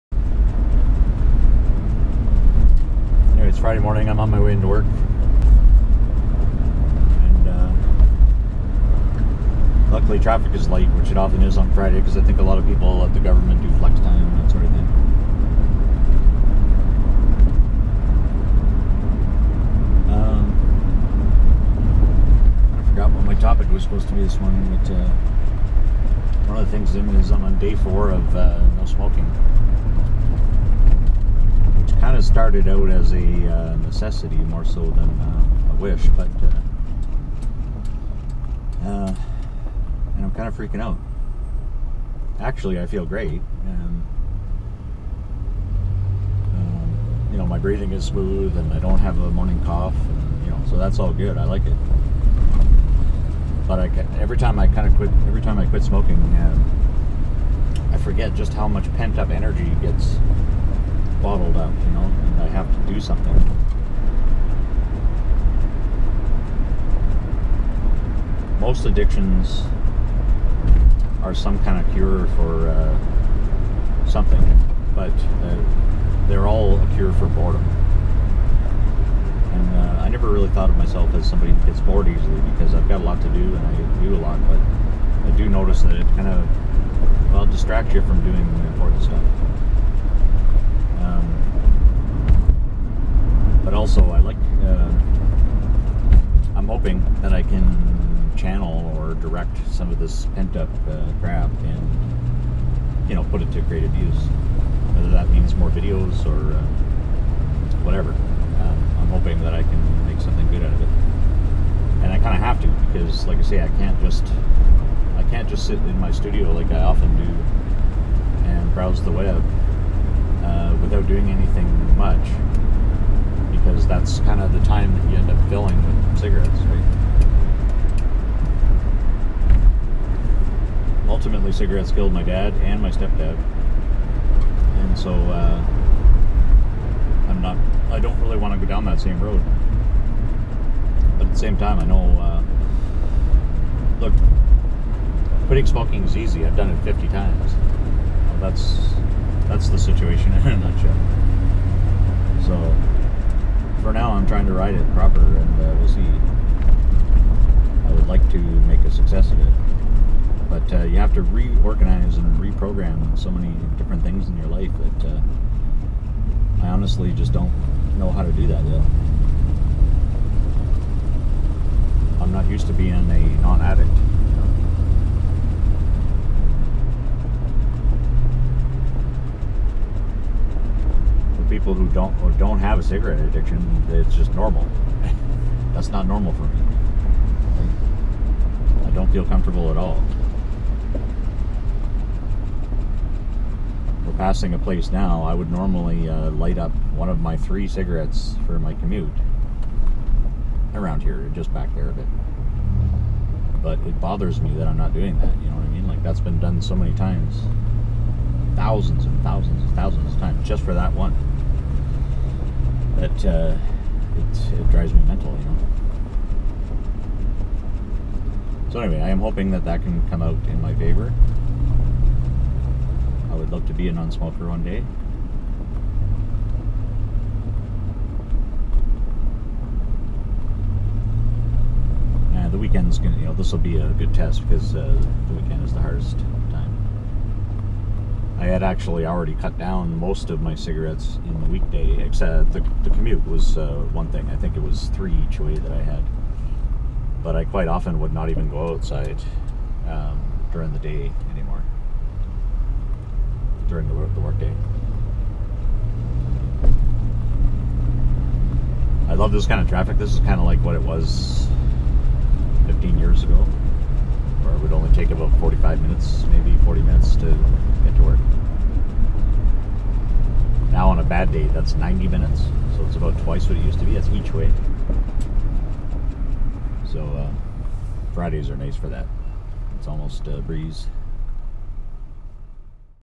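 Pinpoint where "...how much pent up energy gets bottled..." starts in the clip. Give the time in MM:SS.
00:58.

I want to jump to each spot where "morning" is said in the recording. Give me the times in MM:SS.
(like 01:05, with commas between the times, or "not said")
00:03, 00:24, 00:49.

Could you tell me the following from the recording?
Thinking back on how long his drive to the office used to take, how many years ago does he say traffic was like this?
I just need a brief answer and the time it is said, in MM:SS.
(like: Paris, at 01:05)
15, at 04:22.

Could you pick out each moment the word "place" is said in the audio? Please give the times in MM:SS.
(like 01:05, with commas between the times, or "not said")
03:14.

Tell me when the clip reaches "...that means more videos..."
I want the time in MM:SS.
01:45.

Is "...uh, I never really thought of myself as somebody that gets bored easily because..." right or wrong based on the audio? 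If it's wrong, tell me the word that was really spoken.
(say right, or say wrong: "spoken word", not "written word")
right.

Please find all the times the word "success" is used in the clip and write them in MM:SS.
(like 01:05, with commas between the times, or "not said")
02:38.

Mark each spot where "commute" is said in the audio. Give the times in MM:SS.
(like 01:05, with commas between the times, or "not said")
03:18, 04:02.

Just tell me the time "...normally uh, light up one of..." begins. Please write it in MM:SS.
03:15.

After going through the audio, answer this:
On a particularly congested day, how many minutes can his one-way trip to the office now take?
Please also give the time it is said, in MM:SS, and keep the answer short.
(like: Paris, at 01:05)
90, at 04:31.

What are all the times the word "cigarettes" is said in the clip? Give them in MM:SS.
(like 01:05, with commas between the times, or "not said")
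02:06, 02:11, 03:02, 03:17, 04:00.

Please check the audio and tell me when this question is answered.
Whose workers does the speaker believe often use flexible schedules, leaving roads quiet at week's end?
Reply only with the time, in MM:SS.
00:13.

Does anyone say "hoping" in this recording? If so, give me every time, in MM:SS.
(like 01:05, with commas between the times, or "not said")
01:49, 03:39.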